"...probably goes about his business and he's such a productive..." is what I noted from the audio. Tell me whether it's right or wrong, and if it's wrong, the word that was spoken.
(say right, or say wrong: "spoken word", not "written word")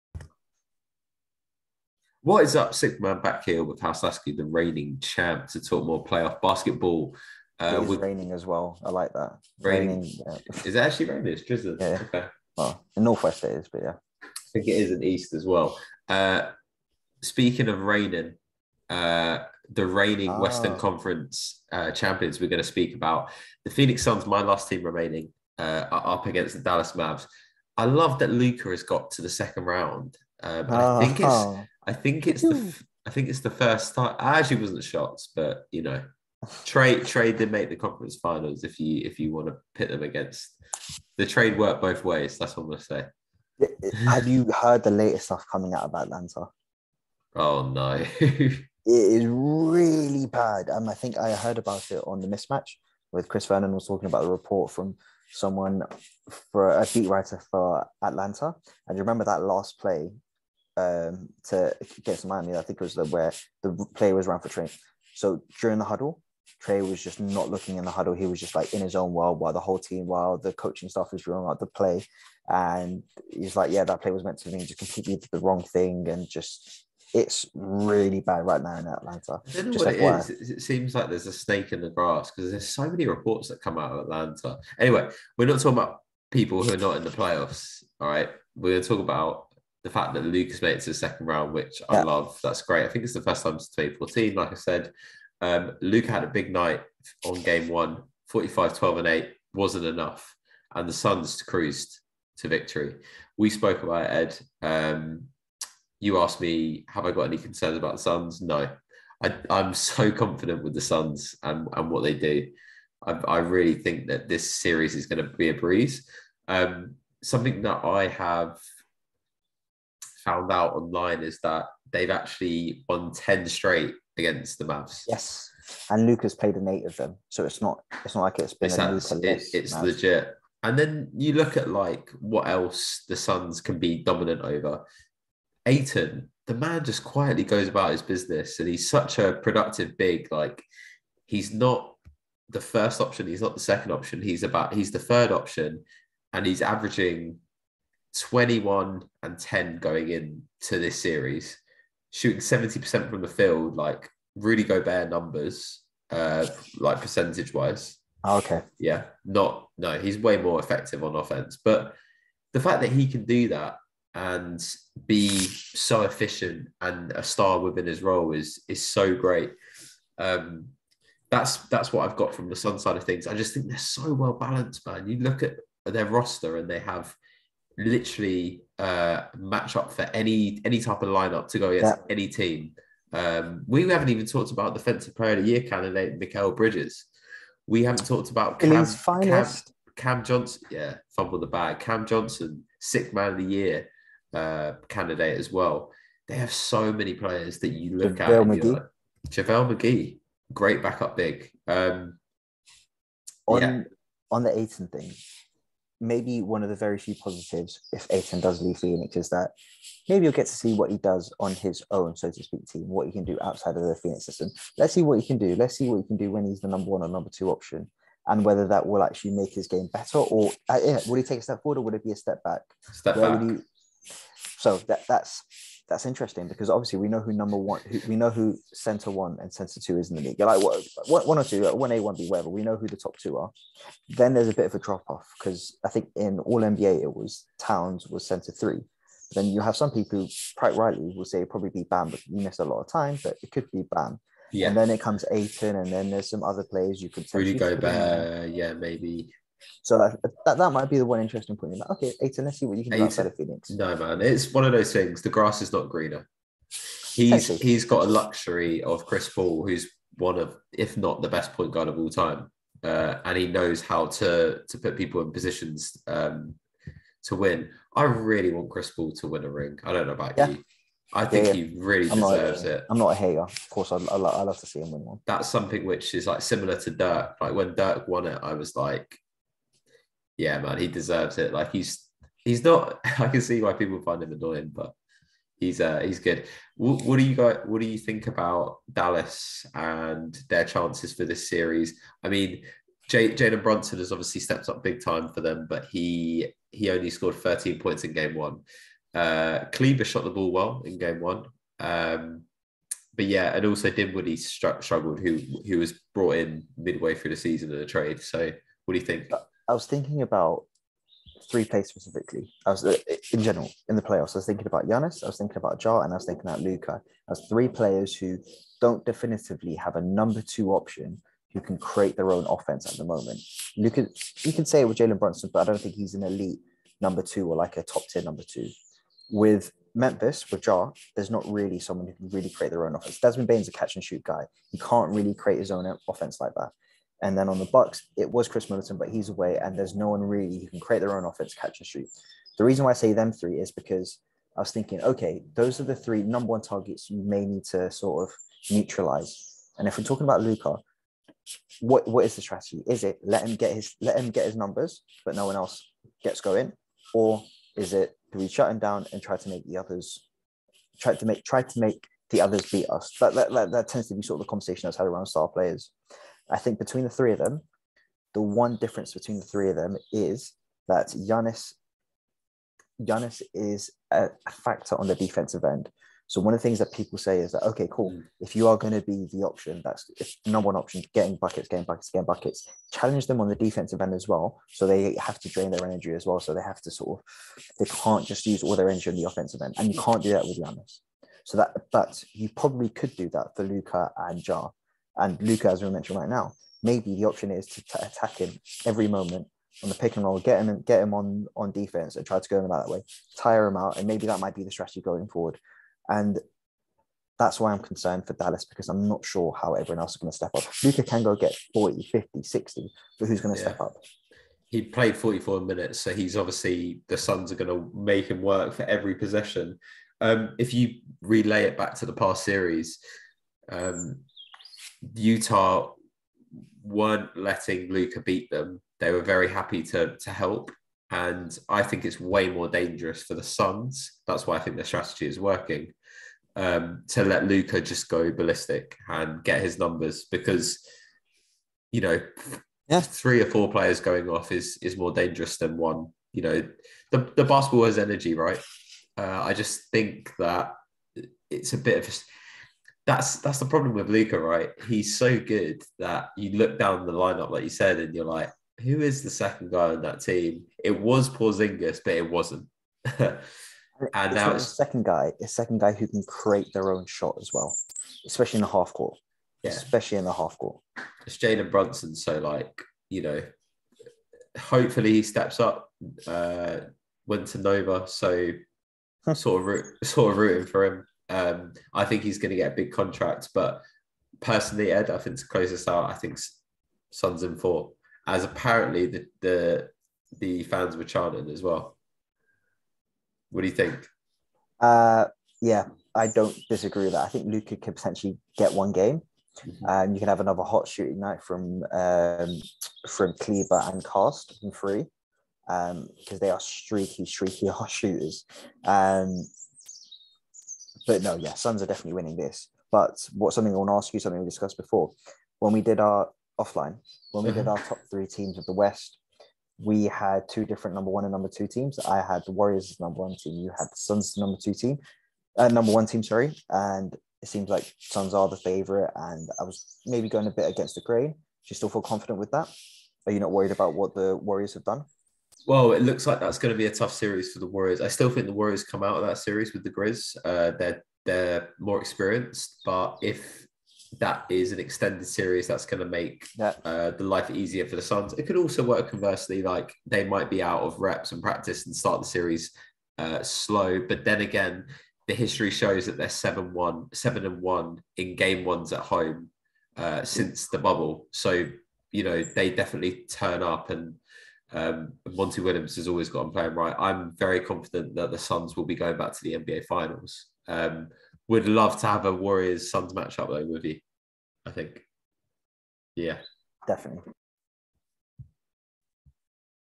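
wrong: "quietly", not "probably".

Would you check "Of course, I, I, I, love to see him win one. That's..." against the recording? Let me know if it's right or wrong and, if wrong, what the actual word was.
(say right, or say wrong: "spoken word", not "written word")
right.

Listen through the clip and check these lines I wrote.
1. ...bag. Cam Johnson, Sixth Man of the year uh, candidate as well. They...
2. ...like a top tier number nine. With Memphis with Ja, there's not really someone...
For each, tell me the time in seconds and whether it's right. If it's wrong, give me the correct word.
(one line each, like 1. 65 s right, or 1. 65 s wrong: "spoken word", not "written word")
1. 191 s right
2. 327 s wrong: "two", not "nine".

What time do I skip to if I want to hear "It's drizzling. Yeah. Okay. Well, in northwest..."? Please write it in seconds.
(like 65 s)
11 s.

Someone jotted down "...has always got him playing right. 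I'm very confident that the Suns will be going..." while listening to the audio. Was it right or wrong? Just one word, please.
right.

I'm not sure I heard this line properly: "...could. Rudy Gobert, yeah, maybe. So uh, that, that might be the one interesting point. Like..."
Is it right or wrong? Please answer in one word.
right.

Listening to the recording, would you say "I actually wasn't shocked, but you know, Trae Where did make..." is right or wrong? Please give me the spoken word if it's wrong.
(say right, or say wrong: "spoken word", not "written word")
wrong: "Trae", not "Where".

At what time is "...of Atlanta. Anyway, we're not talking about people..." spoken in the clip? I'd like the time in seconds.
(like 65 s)
83 s.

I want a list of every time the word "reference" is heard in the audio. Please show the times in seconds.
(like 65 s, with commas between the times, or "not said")
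not said.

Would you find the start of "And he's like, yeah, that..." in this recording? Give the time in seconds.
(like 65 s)
72 s.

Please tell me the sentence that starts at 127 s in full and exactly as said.
So it's not it's not like it's been it's, a it, it's Mavs.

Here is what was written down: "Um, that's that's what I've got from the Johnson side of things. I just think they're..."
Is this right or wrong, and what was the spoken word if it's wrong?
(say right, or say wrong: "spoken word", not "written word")
wrong: "Sun", not "Johnson".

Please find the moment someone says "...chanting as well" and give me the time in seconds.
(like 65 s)
491 s.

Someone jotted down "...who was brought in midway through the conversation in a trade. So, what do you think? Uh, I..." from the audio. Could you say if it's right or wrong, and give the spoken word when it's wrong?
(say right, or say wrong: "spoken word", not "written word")
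wrong: "season", not "conversation".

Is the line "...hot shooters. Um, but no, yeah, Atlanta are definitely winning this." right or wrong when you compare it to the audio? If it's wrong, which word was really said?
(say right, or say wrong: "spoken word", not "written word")
wrong: "Suns", not "Atlanta".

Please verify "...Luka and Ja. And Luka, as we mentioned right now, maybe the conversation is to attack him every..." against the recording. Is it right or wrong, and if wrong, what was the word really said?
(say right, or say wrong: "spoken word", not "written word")
wrong: "option", not "conversation".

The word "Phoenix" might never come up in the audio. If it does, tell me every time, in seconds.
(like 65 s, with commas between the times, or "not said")
23 s, 208 s, 213 s, 253 s.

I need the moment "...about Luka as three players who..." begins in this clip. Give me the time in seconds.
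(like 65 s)
316 s.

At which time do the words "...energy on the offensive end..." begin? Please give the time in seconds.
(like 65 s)
388 s.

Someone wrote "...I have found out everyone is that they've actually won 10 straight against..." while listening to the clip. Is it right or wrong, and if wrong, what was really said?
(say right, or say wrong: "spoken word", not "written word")
wrong: "online", not "everyone".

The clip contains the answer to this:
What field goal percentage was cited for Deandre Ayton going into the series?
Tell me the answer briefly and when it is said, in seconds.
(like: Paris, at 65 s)
70%, at 152 s.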